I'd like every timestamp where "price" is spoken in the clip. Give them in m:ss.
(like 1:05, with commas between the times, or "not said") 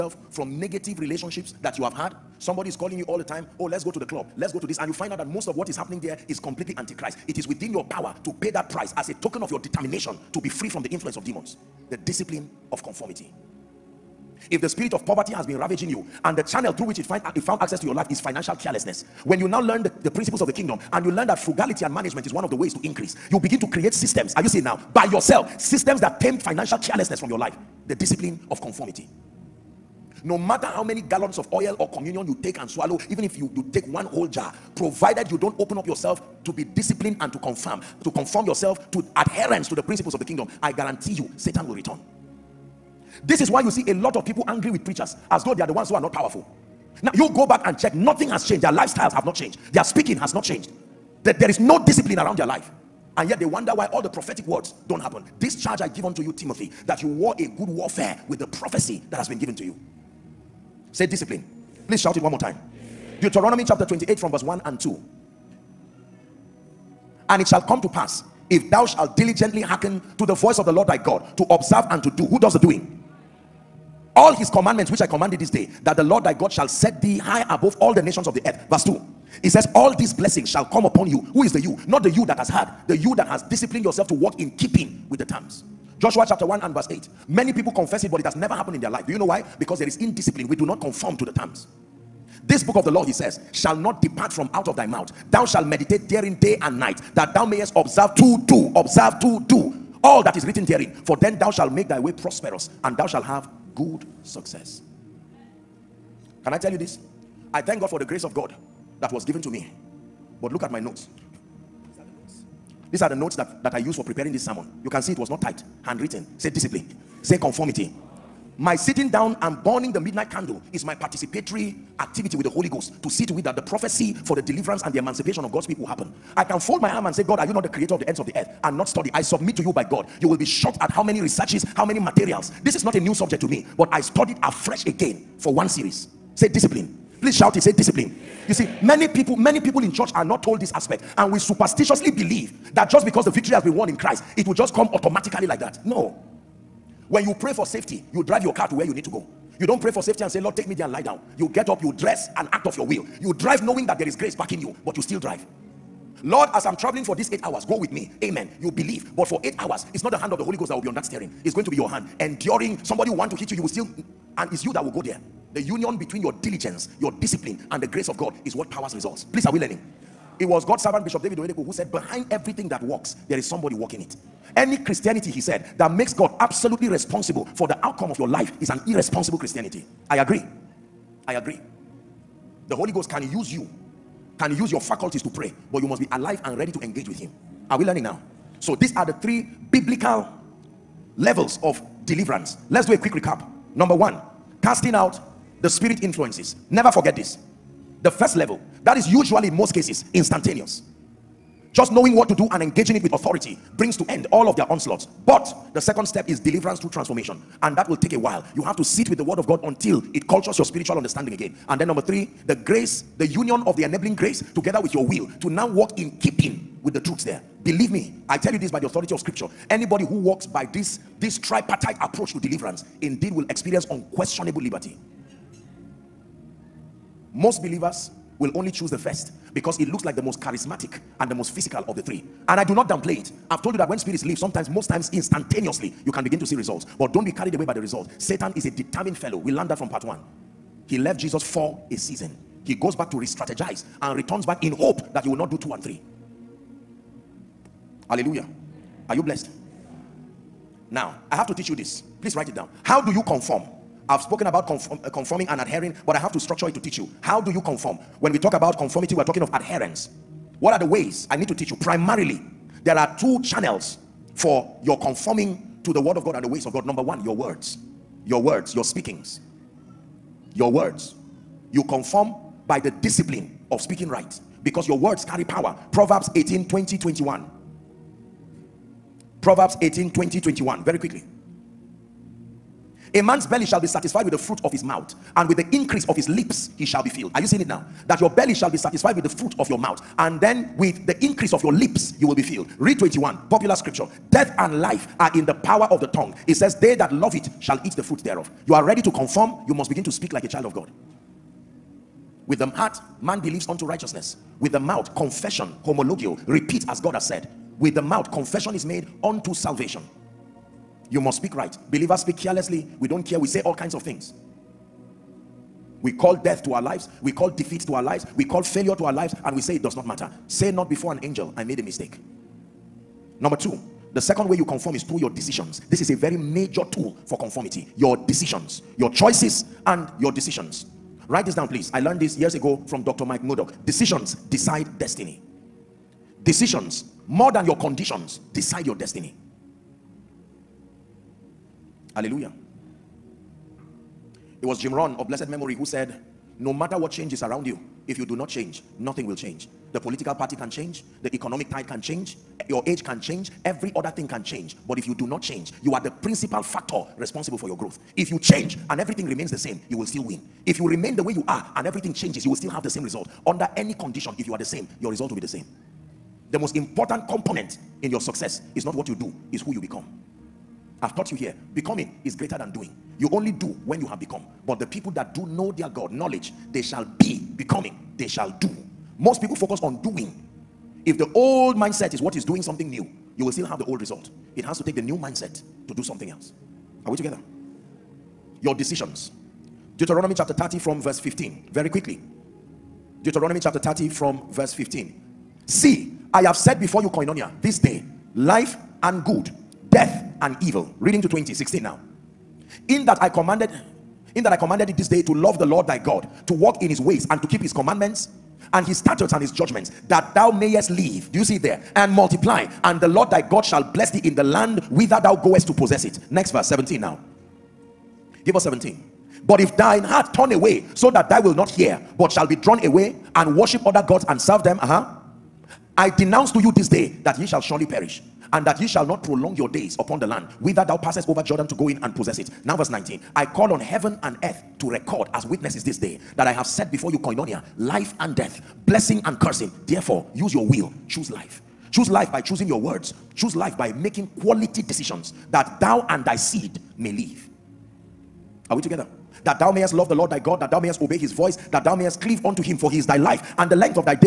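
0:08.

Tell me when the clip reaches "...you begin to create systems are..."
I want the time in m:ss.
0:23.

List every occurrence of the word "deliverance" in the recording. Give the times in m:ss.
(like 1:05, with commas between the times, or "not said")
2:04, 3:12, 3:26, 3:42.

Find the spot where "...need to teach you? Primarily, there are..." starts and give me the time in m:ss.
4:21.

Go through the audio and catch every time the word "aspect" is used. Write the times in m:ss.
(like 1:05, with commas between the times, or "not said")
2:20.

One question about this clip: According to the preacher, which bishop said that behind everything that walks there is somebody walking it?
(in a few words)
David Oyedepo.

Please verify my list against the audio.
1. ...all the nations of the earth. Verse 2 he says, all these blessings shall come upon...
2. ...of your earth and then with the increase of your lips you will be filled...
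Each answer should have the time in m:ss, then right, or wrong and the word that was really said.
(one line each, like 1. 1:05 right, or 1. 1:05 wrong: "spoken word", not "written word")
1. 1:17 right
2. 4:49 wrong: "mouth", not "earth".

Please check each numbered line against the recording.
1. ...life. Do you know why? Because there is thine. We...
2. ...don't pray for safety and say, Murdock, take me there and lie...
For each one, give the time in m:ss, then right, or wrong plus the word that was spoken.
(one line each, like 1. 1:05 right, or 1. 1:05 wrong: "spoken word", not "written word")
1. 1:28 wrong: "indiscipline", not "thine"
2. 2:29 wrong: "Lord", not "Murdock".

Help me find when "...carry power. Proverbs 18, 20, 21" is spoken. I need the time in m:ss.
4:35.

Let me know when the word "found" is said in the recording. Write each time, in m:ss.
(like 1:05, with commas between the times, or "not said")
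0:17.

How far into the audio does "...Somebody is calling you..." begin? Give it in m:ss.
0:02.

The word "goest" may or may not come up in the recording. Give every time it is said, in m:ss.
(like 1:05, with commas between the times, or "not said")
6:55.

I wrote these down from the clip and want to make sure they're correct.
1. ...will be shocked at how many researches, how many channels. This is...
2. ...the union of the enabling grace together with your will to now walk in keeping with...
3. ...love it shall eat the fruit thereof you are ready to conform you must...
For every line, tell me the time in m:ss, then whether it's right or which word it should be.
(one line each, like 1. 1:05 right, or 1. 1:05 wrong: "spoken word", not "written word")
1. 2:10 wrong: "materials", not "channels"
2. 3:33 right
3. 4:57 right.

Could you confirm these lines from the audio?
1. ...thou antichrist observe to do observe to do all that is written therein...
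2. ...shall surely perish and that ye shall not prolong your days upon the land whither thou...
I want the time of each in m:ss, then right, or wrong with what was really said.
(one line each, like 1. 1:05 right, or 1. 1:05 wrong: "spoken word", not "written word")
1. 1:37 wrong: "mayest", not "antichrist"
2. 7:07 right.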